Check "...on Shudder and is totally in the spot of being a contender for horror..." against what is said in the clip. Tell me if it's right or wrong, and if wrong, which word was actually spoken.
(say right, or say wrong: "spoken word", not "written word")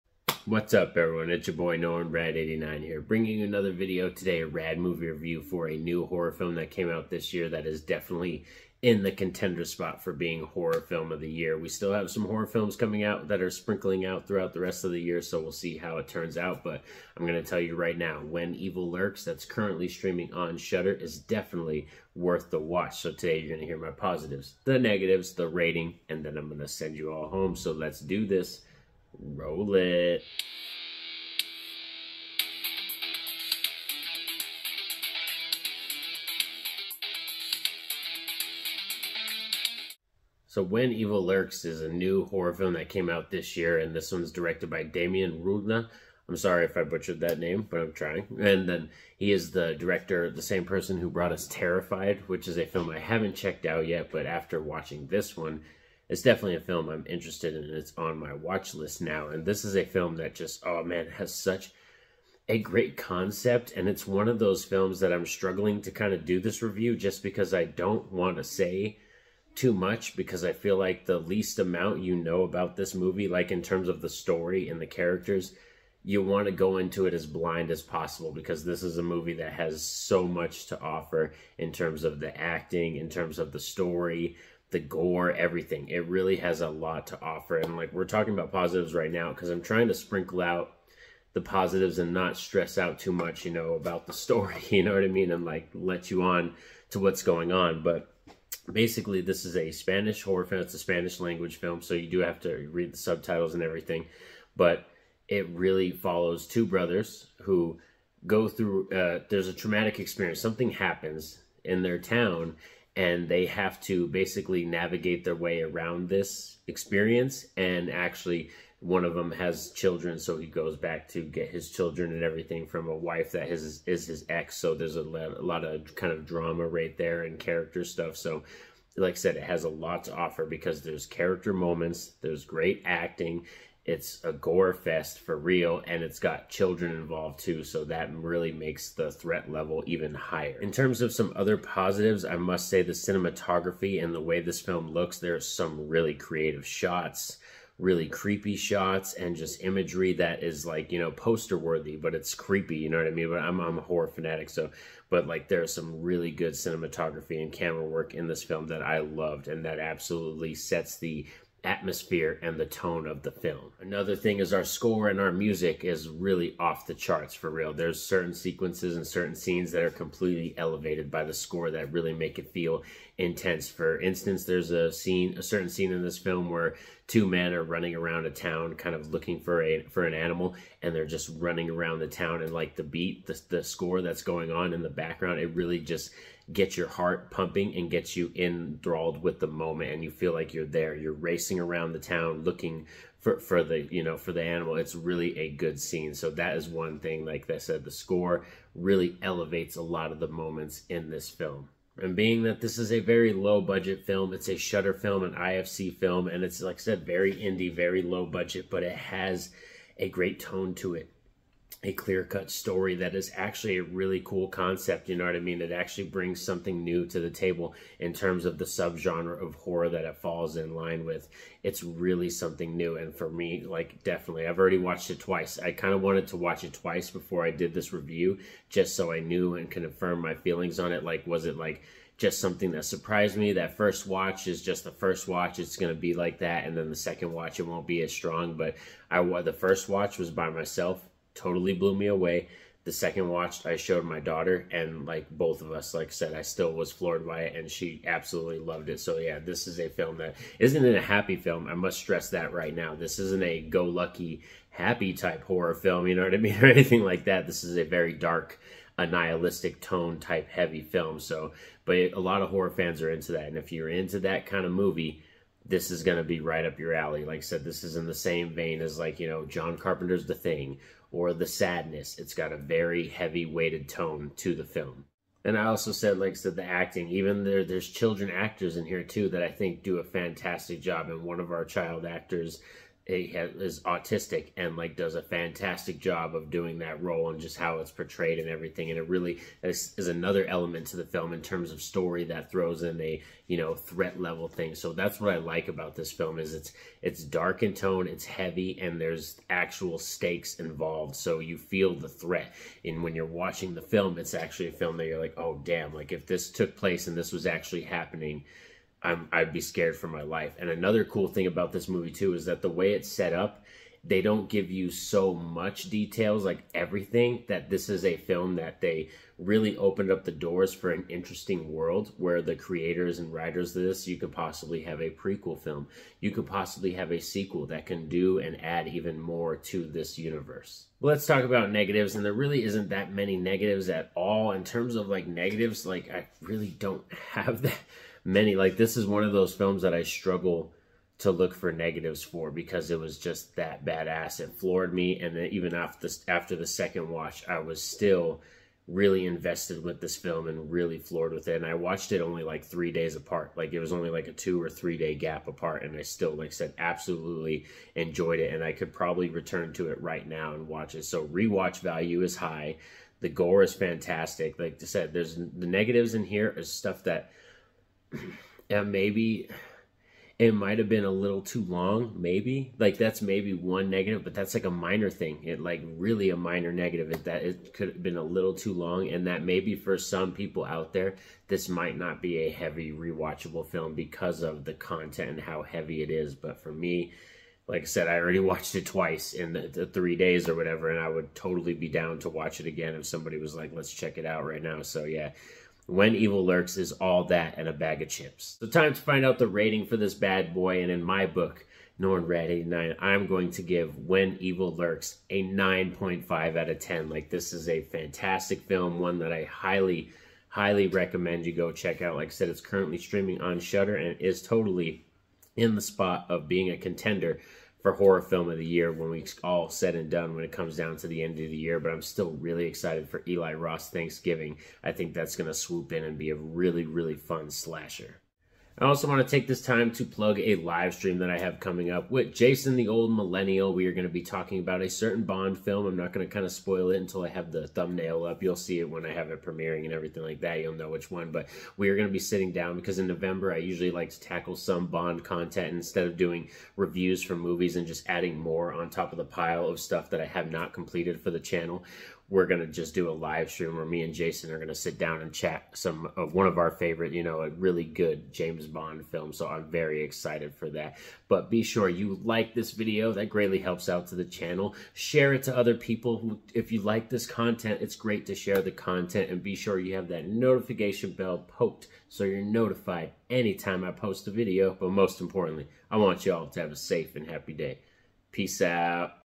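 right.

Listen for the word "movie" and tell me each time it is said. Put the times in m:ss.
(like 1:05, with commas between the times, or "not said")
0:04, 1:12, 1:19, 4:24, 5:11, 7:27.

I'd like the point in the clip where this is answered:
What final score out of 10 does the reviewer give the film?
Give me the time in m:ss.
6:45.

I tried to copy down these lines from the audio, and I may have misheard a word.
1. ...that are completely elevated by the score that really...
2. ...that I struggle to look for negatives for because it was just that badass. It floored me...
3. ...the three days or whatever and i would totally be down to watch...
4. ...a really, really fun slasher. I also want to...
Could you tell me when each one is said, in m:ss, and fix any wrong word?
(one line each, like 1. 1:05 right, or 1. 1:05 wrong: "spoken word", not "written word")
1. 2:49 right
2. 5:39 right
3. 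6:29 right
4. 7:06 right.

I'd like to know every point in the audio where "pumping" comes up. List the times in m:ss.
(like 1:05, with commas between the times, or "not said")
3:07.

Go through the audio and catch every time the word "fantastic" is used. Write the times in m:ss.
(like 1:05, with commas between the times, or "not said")
4:40, 4:45, 6:03, 6:47.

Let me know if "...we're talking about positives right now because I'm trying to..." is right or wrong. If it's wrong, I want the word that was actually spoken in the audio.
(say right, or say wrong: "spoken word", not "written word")
right.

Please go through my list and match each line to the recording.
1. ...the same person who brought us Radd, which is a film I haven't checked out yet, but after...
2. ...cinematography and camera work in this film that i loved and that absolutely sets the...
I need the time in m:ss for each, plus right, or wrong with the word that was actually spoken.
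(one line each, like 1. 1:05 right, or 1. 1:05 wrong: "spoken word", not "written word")
1. 0:50 wrong: "Terrified", not "Radd"
2. 2:36 right.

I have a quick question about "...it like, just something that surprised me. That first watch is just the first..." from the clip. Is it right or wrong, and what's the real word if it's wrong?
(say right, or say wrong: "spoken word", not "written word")
right.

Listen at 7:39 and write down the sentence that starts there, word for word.
So I'm very excited for that.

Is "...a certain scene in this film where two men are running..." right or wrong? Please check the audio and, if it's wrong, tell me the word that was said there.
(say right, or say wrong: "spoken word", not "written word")
right.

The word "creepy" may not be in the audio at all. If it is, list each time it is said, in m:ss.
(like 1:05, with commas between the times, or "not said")
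2:28, 2:32.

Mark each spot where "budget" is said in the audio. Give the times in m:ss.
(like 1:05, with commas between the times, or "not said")
3:23, 3:28.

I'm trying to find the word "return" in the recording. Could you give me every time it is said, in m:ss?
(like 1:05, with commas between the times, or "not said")
5:59.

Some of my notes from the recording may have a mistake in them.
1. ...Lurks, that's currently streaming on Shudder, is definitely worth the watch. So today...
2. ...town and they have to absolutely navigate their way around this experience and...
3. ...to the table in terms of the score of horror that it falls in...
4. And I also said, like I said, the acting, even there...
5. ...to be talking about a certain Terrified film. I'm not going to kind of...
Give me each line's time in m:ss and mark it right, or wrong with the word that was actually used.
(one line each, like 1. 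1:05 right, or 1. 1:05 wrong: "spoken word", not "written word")
1. 0:18 right
2. 1:51 wrong: "basically", not "absolutely"
3. 3:37 wrong: "subgenre", not "score"
4. 4:35 right
5. 7:14 wrong: "Bond", not "Terrified".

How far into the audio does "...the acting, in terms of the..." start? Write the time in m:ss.
1:22.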